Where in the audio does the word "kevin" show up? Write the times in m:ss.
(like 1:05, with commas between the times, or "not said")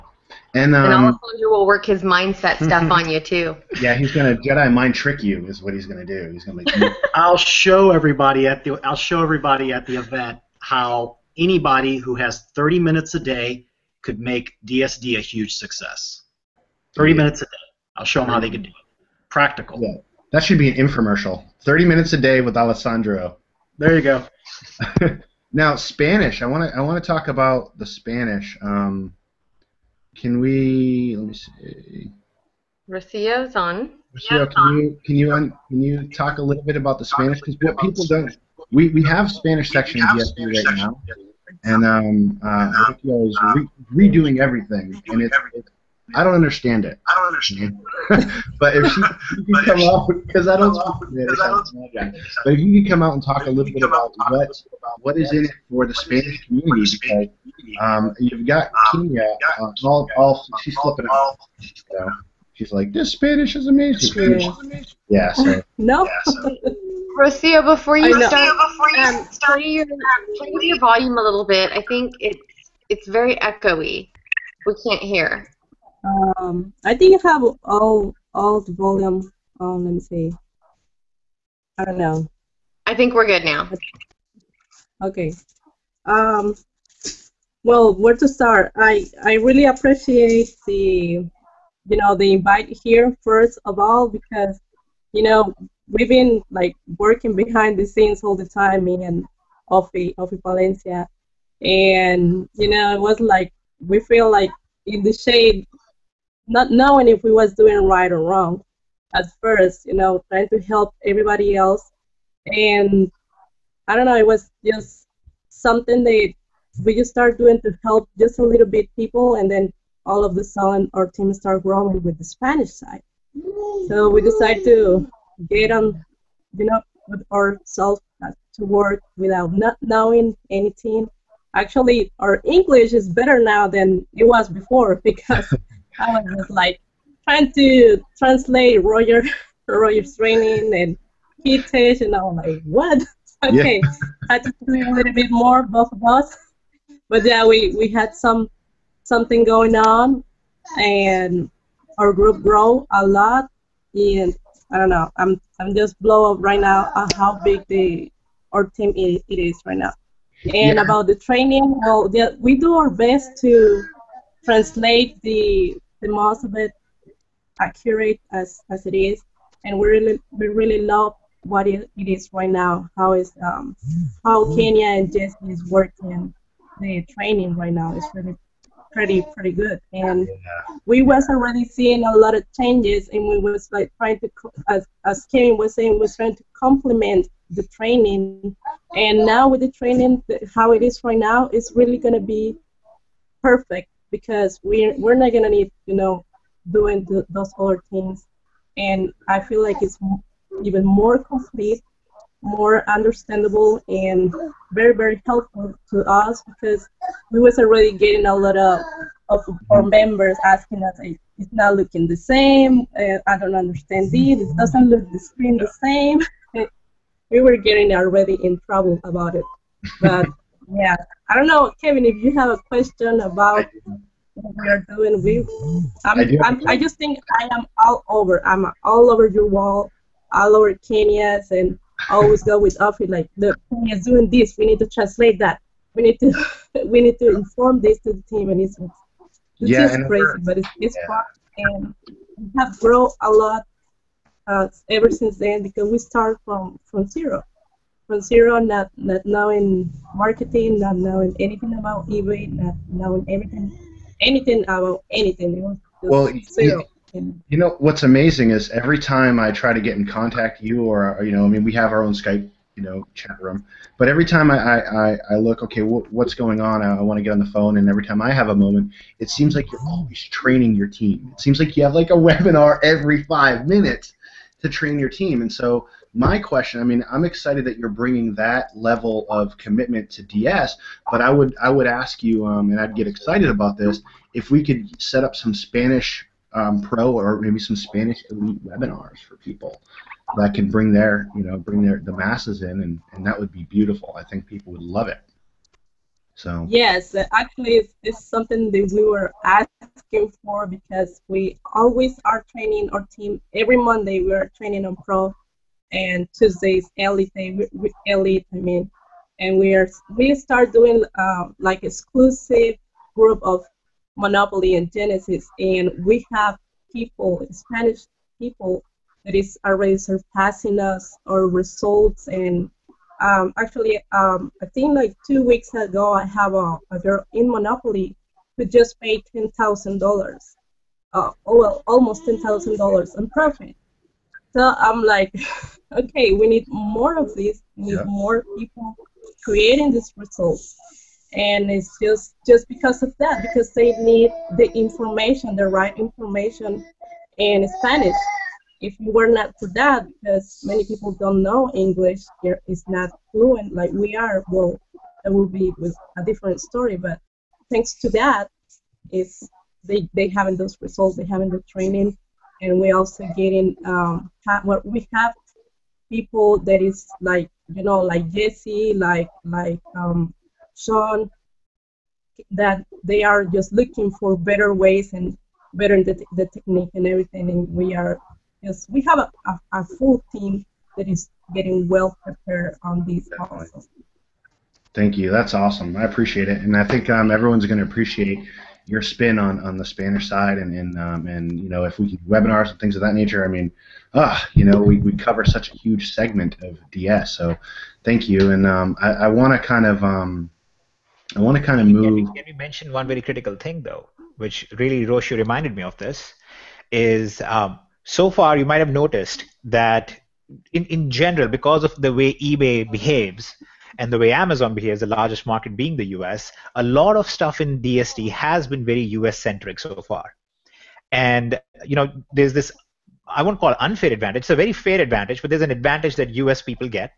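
3:05, 3:41.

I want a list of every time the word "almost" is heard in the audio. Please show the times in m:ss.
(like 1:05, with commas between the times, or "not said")
5:31.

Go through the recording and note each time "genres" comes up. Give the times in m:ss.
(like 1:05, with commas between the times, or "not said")
not said.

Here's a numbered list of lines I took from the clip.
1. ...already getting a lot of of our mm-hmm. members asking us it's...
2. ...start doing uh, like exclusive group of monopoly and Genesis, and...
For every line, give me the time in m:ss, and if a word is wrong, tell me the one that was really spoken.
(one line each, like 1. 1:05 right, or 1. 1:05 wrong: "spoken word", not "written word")
1. 3:27 right
2. 5:10 right.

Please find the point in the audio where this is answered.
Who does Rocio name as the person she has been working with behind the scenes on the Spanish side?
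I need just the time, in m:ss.
1:40.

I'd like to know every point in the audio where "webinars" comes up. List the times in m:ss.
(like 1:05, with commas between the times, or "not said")
4:32, 4:48, 6:32.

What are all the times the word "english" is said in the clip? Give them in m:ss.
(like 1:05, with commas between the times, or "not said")
2:12, 5:51.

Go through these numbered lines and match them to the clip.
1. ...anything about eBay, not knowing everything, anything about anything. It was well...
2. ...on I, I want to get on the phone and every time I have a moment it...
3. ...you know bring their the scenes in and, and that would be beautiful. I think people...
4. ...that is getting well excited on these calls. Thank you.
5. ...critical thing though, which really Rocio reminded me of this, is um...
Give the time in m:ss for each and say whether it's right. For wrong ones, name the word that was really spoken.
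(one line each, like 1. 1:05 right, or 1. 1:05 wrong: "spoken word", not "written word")
1. 4:11 right
2. 4:26 right
3. 4:51 wrong: "masses", not "scenes"
4. 6:20 wrong: "prepared", not "excited"
5. 6:43 right.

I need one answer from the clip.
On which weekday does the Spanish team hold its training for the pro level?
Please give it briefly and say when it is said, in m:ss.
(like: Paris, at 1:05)
Monday, at 5:03.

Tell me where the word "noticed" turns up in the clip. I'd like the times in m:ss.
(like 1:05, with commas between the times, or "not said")
6:48.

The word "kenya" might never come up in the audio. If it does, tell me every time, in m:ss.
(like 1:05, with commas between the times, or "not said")
0:59, 2:54, 3:50.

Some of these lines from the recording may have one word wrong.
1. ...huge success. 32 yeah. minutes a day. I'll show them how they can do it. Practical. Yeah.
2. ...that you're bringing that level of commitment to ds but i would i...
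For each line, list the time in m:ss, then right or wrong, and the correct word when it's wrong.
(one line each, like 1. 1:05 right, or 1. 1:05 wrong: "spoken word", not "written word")
1. 0:15 wrong: "30", not "32"
2. 4:37 right.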